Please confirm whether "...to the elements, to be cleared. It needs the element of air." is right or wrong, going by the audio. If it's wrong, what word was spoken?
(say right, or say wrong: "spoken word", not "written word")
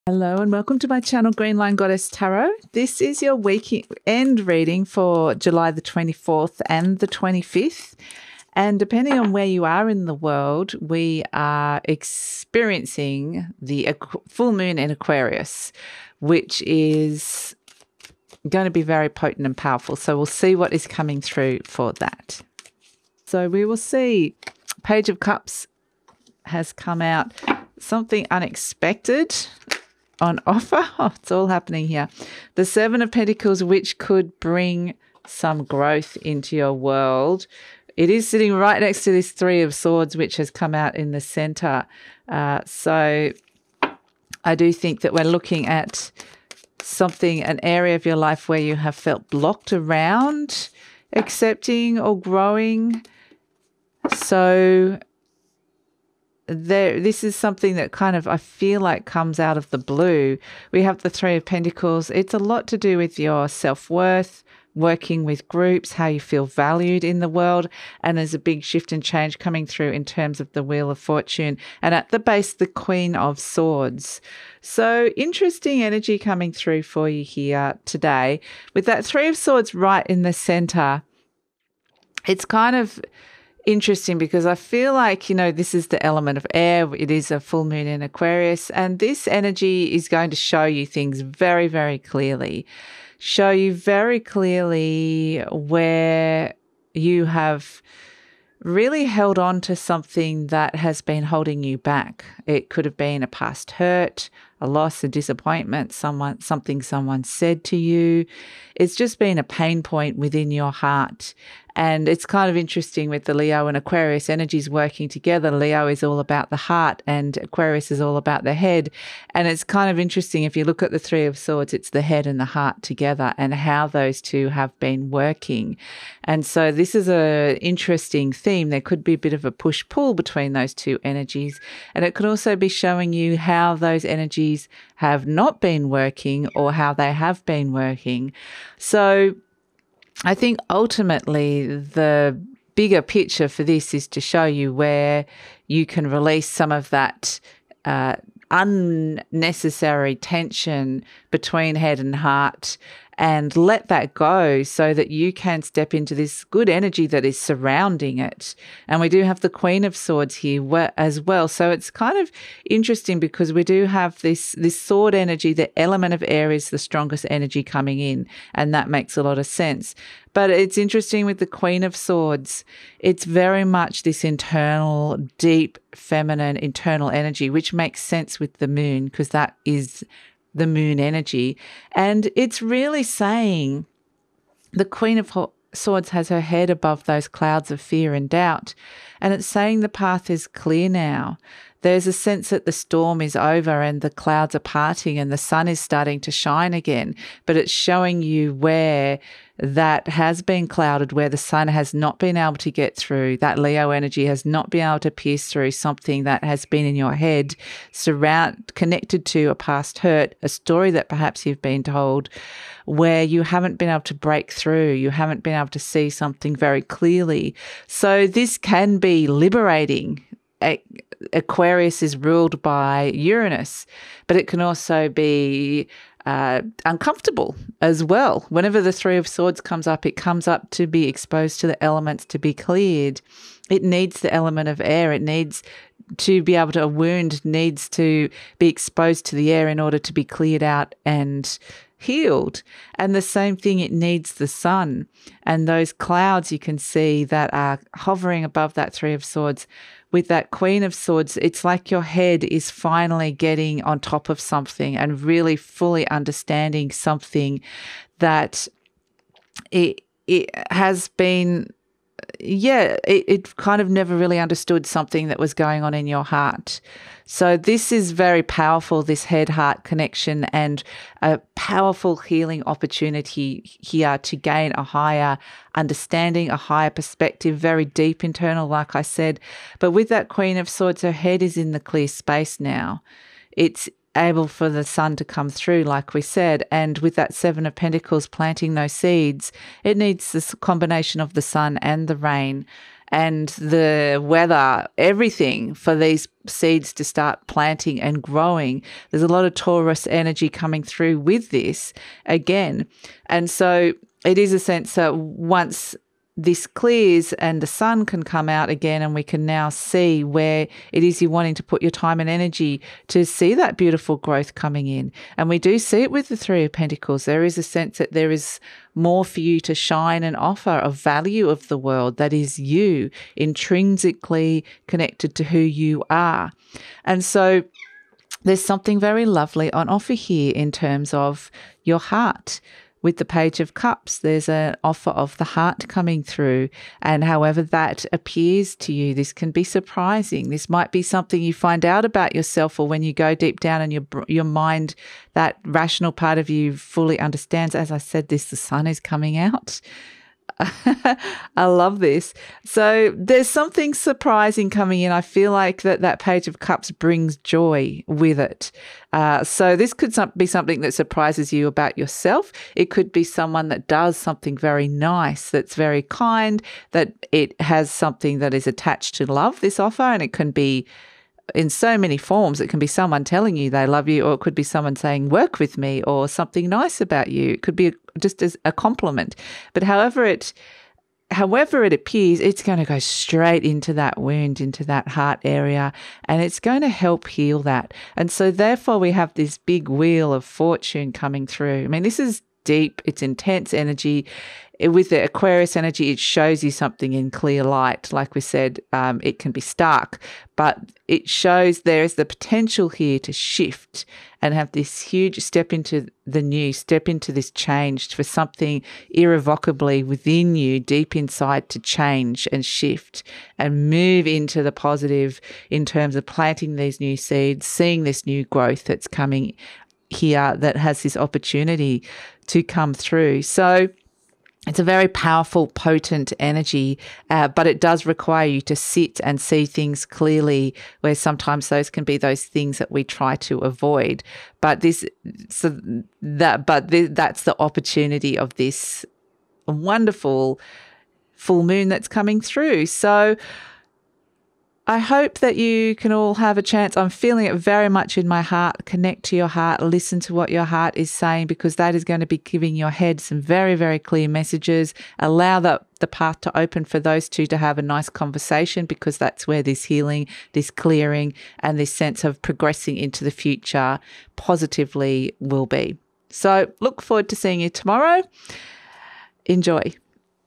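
right.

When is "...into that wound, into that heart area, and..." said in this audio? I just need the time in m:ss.
6:23.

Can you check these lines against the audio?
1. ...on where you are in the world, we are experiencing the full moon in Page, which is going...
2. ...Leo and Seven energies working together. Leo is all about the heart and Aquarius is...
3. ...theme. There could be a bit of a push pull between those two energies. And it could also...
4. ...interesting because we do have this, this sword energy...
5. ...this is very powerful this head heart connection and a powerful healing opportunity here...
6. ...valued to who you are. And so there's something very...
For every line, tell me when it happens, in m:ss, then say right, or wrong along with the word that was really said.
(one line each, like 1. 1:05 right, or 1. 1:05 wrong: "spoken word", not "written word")
1. 0:09 wrong: "Aquarius", not "Page"
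2. 1:53 wrong: "Aquarius", not "Seven"
3. 2:08 right
4. 2:42 right
5. 4:27 right
6. 5:24 wrong: "connected", not "valued".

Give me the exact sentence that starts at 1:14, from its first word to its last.
So interesting energy coming through for you here today with that three of swords right in the center.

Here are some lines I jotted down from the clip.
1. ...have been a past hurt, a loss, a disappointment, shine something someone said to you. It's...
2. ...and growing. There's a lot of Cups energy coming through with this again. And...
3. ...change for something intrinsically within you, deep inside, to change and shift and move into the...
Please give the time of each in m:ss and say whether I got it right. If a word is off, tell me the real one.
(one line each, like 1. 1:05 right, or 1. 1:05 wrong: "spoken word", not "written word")
1. 1:42 wrong: "someone", not "shine"
2. 4:58 wrong: "Taurus", not "Cups"
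3. 6:47 wrong: "irrevocably", not "intrinsically".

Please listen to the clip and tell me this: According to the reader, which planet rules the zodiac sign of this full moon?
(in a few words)
Uranus.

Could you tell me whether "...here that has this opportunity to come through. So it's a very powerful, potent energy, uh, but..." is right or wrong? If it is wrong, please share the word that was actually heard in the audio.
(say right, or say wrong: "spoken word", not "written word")
right.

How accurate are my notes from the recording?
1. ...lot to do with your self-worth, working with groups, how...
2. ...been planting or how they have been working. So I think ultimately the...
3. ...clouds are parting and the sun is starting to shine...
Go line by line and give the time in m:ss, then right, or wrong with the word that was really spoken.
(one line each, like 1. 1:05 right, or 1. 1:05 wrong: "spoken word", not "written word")
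1. 1:02 right
2. 2:15 wrong: "working", not "planting"
3. 3:14 right.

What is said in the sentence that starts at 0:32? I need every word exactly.
The Seven of Pentacles, which could bring some growth into your world.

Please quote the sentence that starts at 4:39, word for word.
But with that Queen of Swords, her head is in the clear space now.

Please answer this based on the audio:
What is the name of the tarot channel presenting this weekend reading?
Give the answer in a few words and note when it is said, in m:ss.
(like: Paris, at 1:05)
GreenLion Goddess Tarot, at 0:01.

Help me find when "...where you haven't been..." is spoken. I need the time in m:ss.
3:32.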